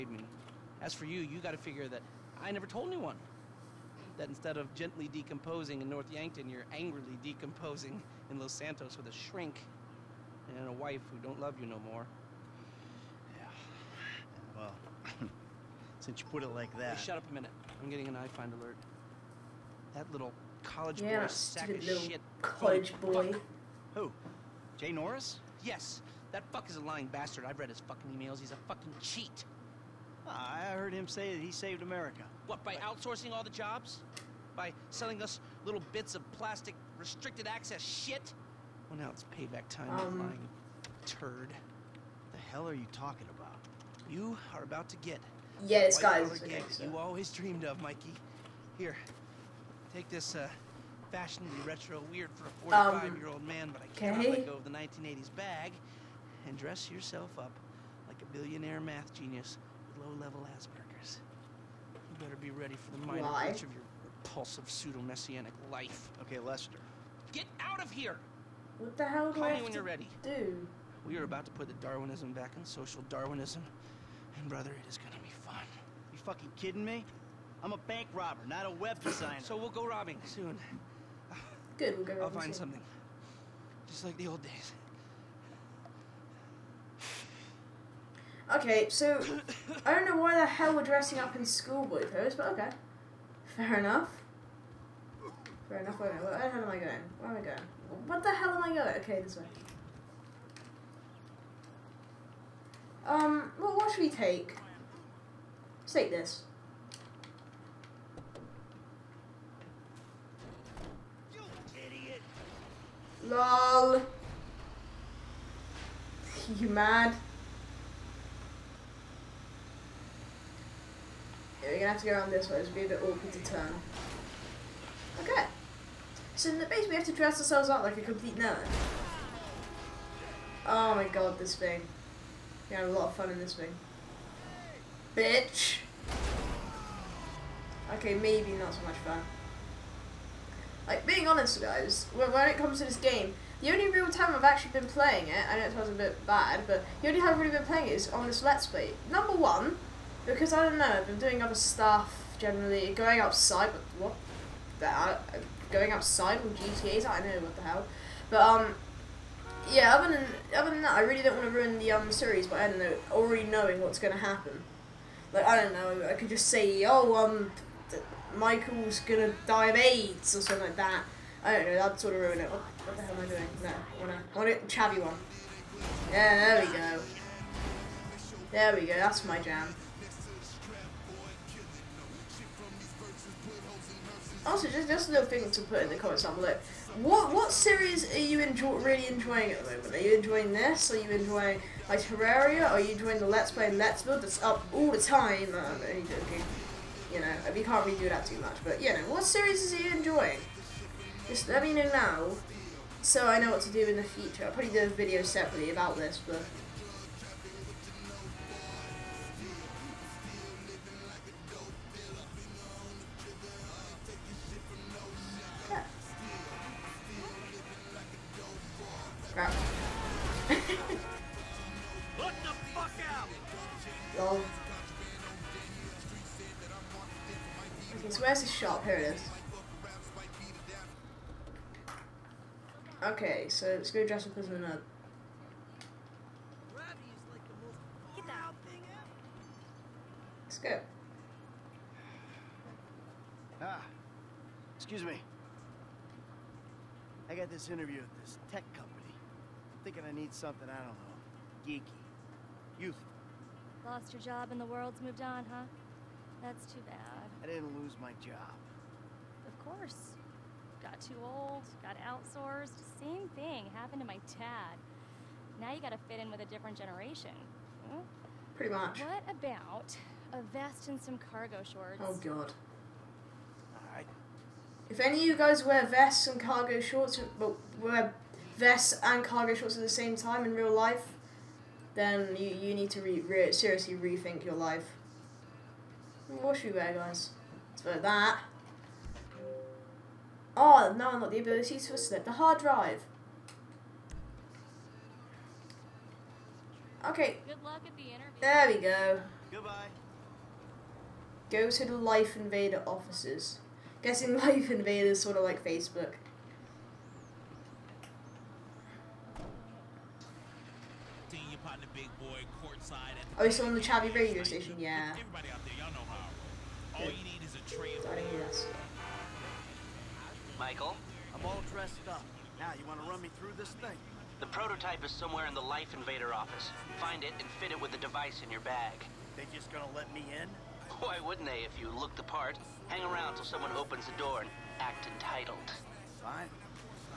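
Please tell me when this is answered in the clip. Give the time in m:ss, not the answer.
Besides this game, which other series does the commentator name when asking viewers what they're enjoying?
3:12.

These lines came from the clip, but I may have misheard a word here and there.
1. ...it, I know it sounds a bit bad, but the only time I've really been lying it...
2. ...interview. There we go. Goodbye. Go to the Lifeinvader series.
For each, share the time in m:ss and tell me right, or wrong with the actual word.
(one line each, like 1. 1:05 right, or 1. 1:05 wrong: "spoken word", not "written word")
1. 2:25 wrong: "playing", not "lying"
2. 4:58 wrong: "offices", not "series".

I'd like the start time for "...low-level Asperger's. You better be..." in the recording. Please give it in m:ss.
1:00.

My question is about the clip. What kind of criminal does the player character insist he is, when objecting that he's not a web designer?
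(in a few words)
Bank robber.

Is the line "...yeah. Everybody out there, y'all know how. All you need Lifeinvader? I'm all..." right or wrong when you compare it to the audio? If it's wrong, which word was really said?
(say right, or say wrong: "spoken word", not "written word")
wrong: "Michael", not "Lifeinvader".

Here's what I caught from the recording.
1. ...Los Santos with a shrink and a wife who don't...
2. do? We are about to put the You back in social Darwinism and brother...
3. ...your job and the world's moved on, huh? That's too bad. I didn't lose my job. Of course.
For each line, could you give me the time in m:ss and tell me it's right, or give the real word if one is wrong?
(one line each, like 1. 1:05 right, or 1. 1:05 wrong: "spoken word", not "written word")
1. 0:08 right
2. 1:10 wrong: "Darwinism", not "You"
3. 4:14 right.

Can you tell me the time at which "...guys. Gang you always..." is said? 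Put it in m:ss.
0:45.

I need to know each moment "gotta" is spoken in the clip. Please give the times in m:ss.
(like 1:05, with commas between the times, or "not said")
0:01, 4:25.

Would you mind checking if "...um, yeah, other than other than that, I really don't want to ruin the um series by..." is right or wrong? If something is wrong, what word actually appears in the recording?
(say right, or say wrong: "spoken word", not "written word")
right.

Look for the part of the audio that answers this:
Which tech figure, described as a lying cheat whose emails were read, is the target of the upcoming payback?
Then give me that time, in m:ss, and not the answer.
0:24.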